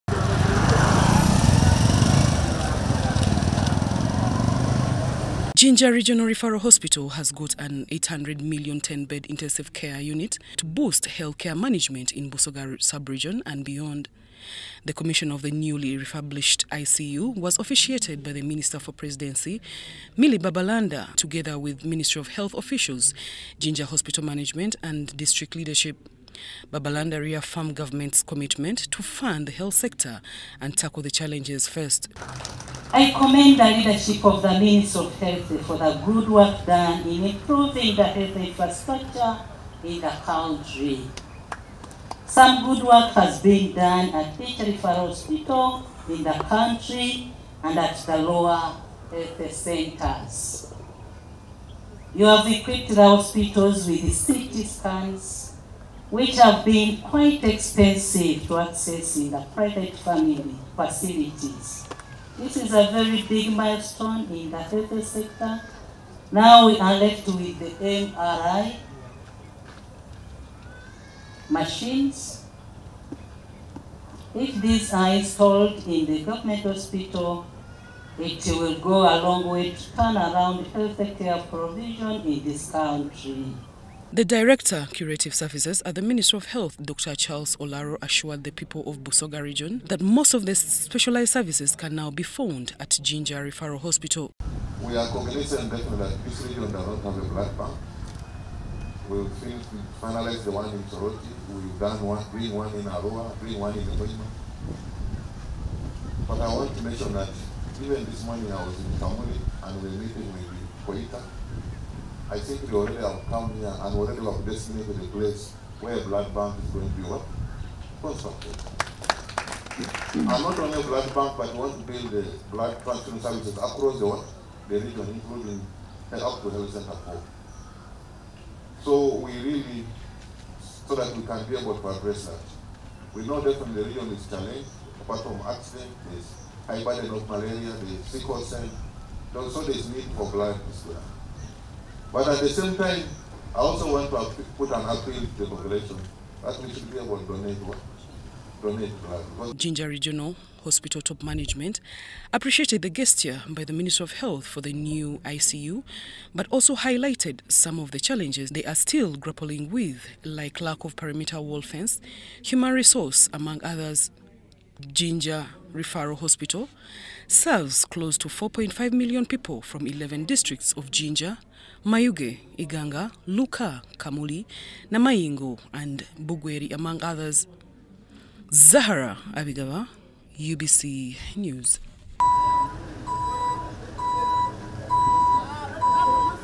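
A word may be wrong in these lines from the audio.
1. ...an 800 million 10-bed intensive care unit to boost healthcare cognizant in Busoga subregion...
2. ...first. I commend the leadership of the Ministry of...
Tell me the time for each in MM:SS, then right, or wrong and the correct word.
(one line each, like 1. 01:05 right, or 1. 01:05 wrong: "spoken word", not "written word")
1. 00:07 wrong: "management", not "cognizant"
2. 00:31 right.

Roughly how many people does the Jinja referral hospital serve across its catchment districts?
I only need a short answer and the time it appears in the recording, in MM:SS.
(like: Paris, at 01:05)
4.5 million, at 02:48.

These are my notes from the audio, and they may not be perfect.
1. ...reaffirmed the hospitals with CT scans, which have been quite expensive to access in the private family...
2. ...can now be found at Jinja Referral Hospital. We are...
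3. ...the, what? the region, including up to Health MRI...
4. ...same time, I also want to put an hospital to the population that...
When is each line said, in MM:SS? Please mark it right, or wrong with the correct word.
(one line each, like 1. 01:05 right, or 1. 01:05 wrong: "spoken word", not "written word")
1. 00:52 wrong: "equipped", not "reaffirmed"
2. 01:31 right
3. 02:03 wrong: "Center", not "MRI"
4. 02:22 wrong: "appeal", not "hospital".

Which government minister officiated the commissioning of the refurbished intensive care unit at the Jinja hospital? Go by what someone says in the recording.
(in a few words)
Milly Babalanda.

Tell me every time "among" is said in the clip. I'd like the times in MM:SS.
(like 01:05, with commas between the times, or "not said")
02:43, 02:56.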